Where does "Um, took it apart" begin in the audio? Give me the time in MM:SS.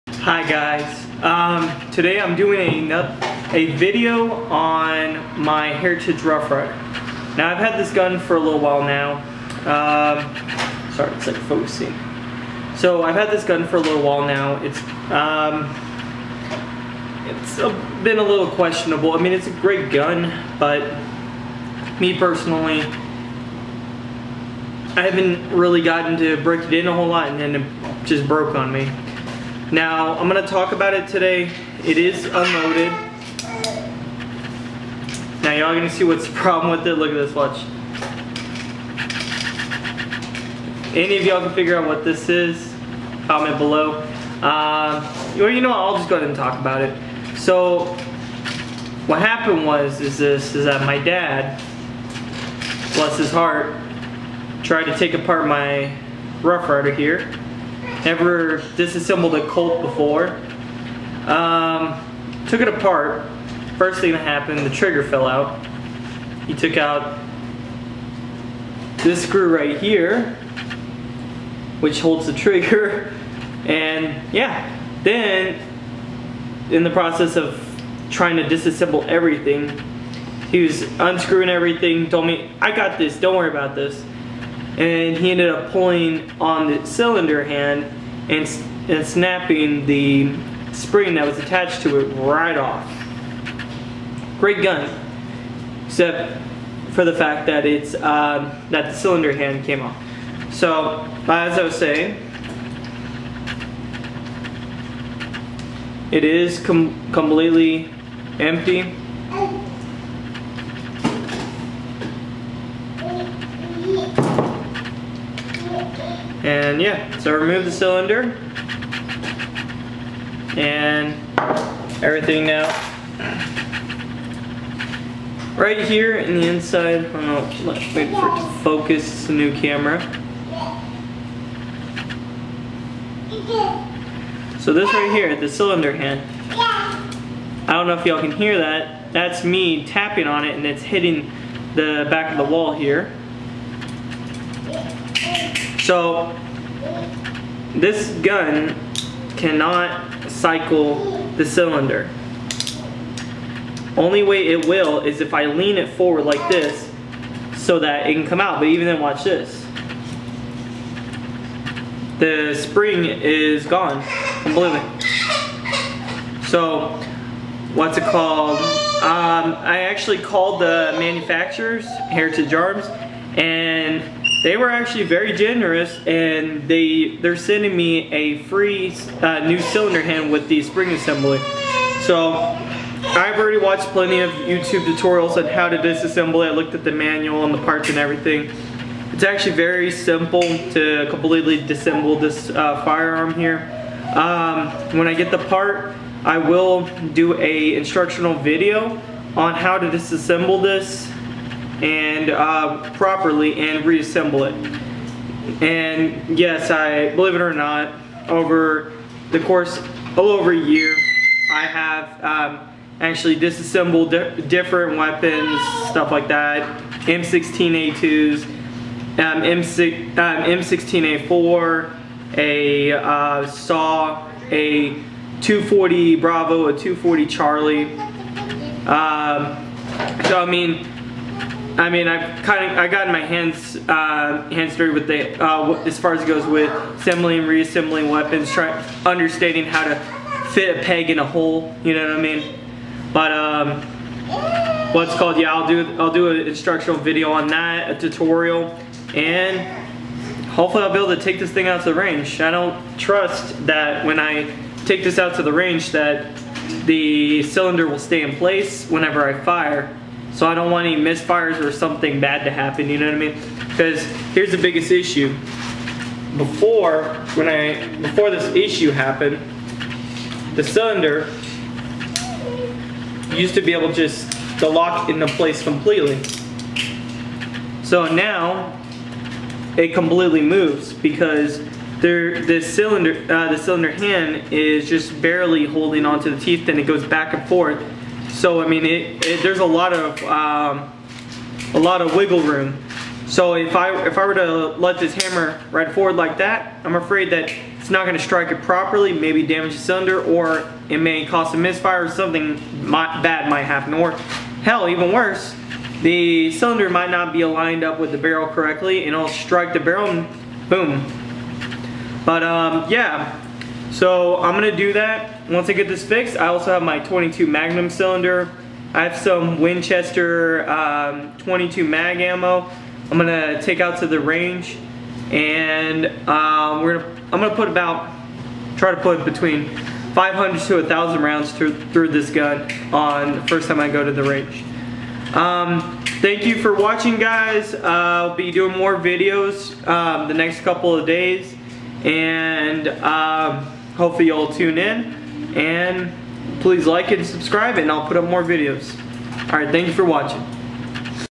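01:01.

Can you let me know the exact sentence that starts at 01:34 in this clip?
Great gun, except for the fact that it's uh, that the cylinder hand came off.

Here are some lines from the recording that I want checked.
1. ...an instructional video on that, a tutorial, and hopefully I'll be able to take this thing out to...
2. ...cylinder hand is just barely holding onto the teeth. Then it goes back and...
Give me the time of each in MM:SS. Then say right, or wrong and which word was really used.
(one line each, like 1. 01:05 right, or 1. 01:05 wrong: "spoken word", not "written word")
1. 04:06 right
2. 04:43 right.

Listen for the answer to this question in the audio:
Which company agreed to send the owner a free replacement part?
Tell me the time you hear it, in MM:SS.
02:52.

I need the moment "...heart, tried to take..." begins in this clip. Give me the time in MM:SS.
00:53.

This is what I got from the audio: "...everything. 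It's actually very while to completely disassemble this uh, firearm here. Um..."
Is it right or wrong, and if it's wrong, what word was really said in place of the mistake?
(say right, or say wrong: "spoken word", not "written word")
wrong: "simple", not "while".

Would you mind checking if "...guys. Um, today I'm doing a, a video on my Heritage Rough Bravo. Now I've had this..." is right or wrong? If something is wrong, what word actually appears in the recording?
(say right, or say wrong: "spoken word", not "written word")
wrong: "Rider", not "Bravo".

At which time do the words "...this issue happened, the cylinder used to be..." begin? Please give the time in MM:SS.
04:28.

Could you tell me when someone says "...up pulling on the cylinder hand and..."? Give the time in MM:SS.
01:25.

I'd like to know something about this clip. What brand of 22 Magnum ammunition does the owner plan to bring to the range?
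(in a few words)
Winchester.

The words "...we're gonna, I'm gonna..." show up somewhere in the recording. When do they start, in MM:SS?
05:26.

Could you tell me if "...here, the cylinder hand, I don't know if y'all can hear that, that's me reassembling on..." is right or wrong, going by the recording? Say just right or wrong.
wrong.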